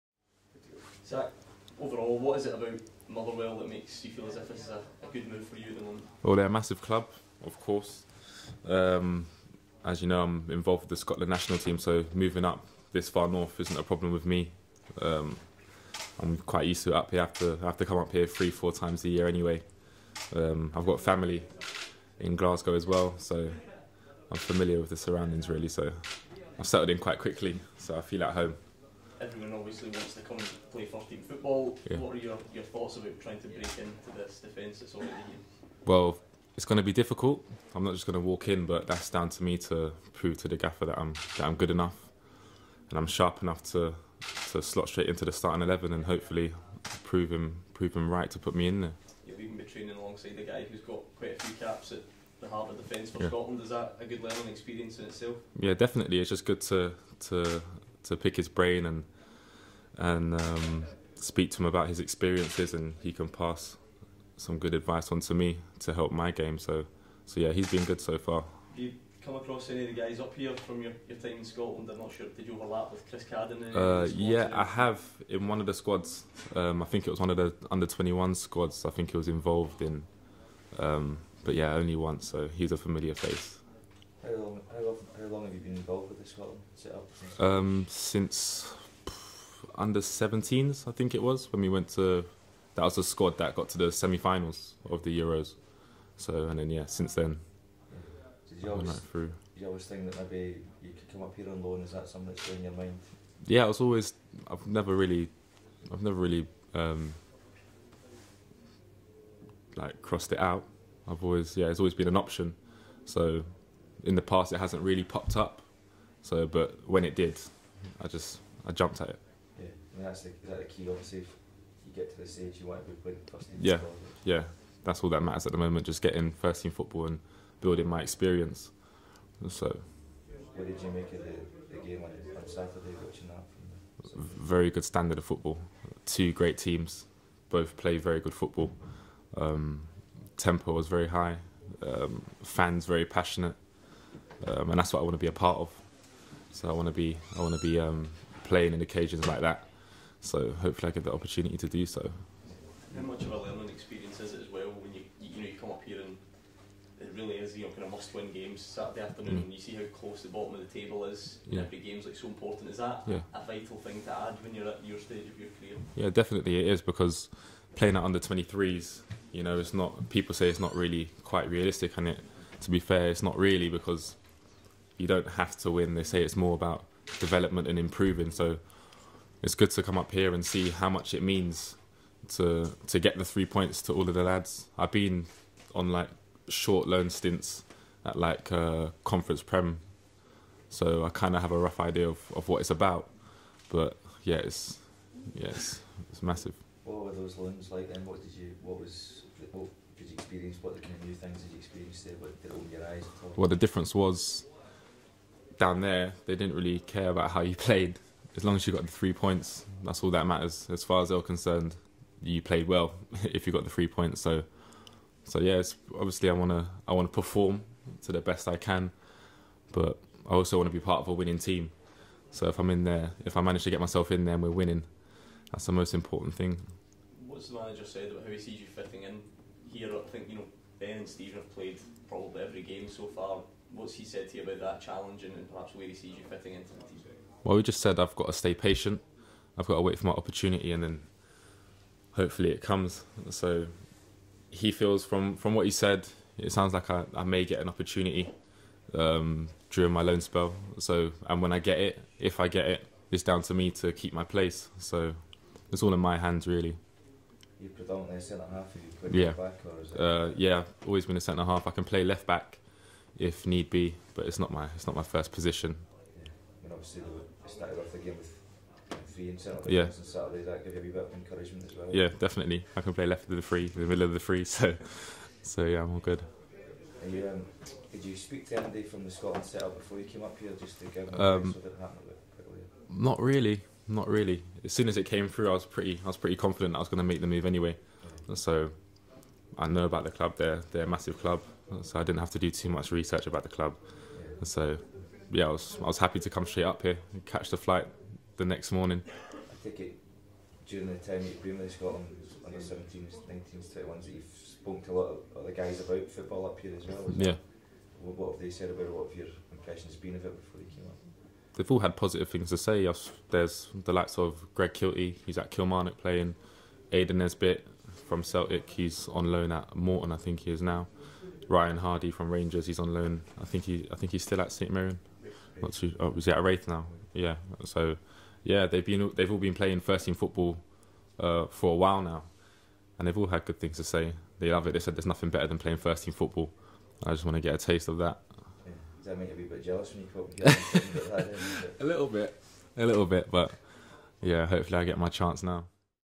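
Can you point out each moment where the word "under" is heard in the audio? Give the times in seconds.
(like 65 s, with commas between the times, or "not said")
77 s, 89 s, 168 s, 302 s.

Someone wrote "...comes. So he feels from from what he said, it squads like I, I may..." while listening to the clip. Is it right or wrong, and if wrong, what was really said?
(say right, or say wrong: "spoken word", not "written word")
wrong: "sounds", not "squads".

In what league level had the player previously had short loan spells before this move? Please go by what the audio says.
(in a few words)
conference prem.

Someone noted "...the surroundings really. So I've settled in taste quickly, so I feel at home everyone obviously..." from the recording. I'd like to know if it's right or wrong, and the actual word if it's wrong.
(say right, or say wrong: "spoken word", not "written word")
wrong: "quite", not "taste".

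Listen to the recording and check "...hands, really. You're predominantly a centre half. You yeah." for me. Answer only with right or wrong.
right.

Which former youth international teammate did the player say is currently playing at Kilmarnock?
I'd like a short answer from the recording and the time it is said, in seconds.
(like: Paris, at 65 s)
Greg Kilty, at 314 s.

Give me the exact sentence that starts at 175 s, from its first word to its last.
They say it's more about development and improving.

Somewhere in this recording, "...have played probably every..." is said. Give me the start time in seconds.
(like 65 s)
231 s.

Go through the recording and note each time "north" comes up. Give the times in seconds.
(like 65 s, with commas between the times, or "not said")
13 s.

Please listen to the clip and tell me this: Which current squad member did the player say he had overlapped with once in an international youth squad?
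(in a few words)
Chris Cadden.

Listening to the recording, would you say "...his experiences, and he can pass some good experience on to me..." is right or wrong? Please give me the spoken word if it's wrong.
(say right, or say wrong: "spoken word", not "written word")
wrong: "advice", not "experience".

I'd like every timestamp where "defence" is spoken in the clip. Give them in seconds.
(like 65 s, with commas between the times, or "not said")
34 s, 52 s.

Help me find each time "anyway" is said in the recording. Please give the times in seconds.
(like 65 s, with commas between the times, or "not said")
19 s, 287 s.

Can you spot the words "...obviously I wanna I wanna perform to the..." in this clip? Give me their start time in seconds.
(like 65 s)
215 s.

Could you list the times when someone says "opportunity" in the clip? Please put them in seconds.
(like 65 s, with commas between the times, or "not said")
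151 s, 240 s, 247 s.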